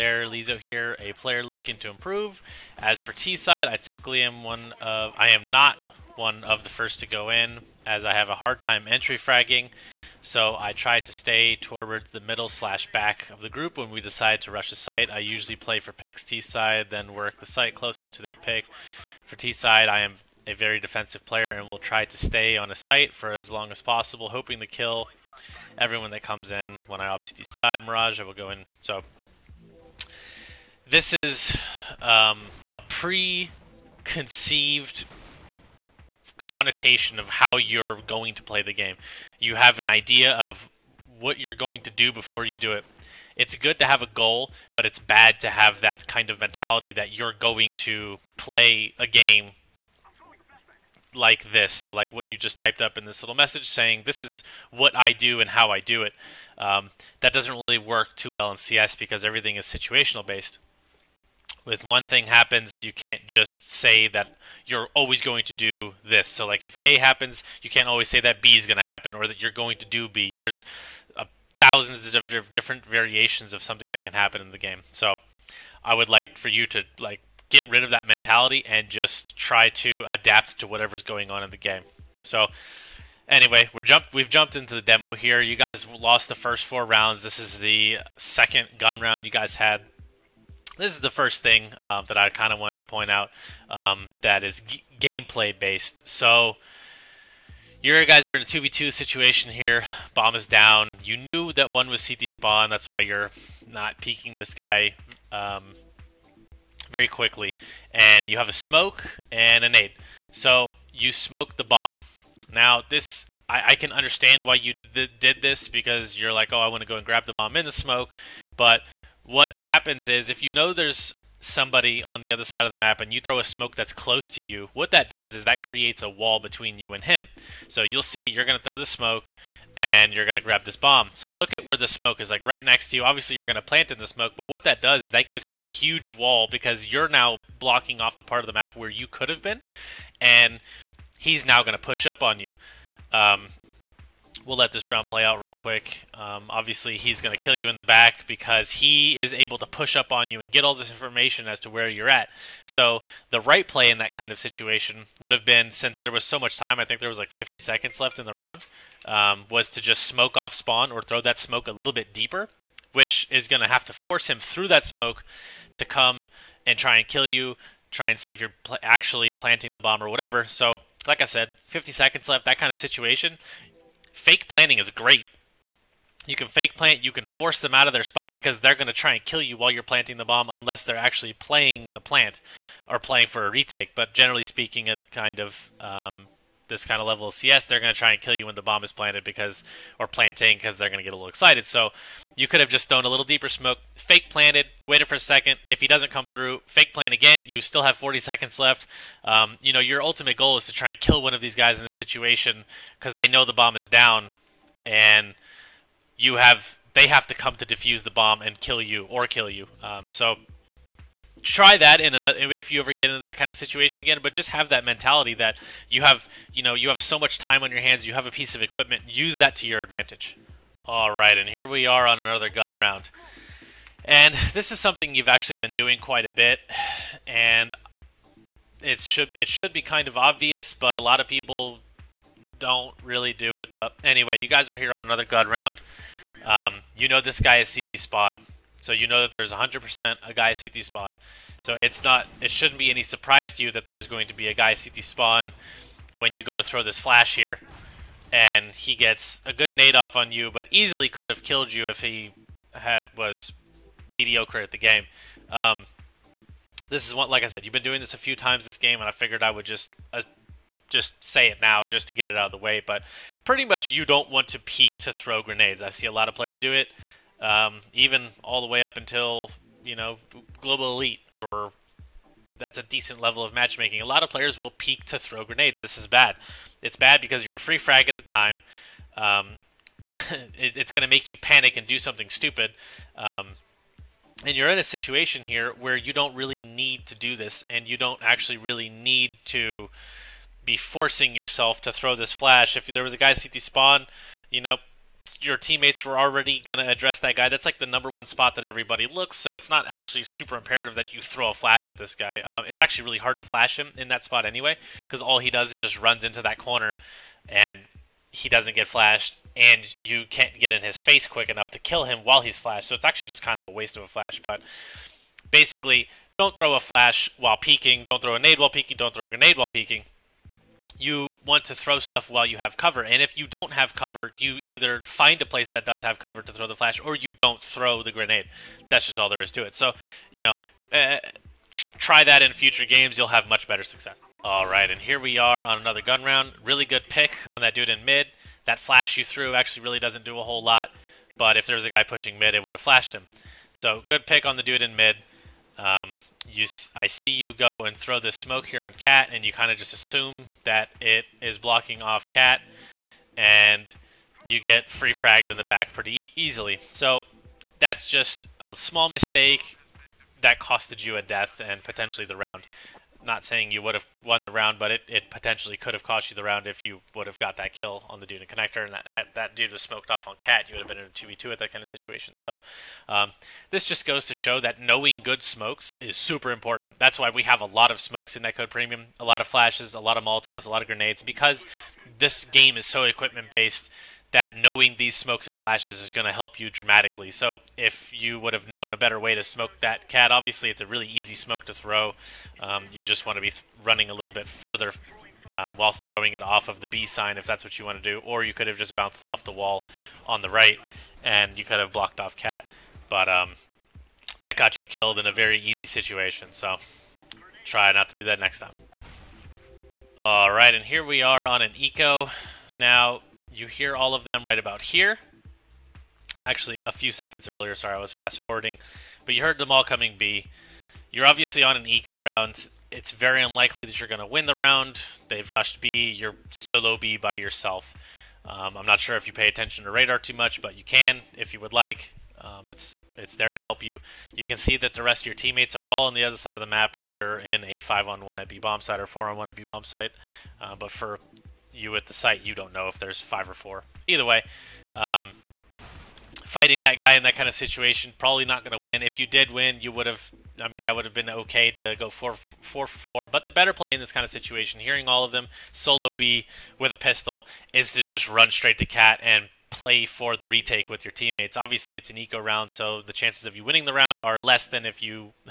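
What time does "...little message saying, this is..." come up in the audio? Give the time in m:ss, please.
0:53.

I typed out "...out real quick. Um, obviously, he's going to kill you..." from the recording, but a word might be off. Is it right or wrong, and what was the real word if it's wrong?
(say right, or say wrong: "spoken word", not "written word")
right.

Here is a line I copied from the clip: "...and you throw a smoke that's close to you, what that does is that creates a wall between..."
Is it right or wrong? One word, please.
right.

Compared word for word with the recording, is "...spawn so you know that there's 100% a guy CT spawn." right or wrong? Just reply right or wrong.
right.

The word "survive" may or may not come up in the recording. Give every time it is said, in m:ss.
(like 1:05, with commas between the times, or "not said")
not said.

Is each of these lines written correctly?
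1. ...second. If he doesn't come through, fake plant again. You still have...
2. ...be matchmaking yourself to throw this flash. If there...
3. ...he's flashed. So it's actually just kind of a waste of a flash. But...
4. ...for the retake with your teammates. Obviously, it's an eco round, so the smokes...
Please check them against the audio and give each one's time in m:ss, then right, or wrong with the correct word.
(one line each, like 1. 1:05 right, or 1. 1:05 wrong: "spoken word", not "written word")
1. 3:15 right
2. 4:50 wrong: "forcing", not "matchmaking"
3. 5:12 right
4. 7:40 wrong: "chances", not "smokes".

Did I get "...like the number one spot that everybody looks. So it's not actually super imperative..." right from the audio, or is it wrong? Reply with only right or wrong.
right.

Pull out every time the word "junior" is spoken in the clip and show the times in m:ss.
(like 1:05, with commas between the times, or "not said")
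not said.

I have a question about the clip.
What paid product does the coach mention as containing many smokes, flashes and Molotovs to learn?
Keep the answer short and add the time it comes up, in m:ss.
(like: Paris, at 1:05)
Netcode Premium, at 6:18.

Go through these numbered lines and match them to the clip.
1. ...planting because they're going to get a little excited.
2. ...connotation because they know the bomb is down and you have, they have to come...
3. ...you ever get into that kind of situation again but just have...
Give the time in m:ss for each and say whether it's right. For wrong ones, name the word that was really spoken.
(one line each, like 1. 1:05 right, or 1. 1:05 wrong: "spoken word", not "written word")
1. 3:10 right
2. 3:21 wrong: "situation", not "connotation"
3. 3:32 right.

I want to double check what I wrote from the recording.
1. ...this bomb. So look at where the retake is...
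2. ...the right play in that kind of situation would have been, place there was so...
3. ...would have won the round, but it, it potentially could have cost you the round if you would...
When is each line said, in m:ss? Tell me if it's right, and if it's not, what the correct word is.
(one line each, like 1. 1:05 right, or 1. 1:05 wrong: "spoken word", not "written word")
1. 2:10 wrong: "smoke", not "retake"
2. 2:33 wrong: "since", not "place"
3. 6:03 right.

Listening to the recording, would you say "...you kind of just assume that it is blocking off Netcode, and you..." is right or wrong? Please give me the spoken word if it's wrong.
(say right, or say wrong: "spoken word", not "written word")
wrong: "Cat", not "Netcode".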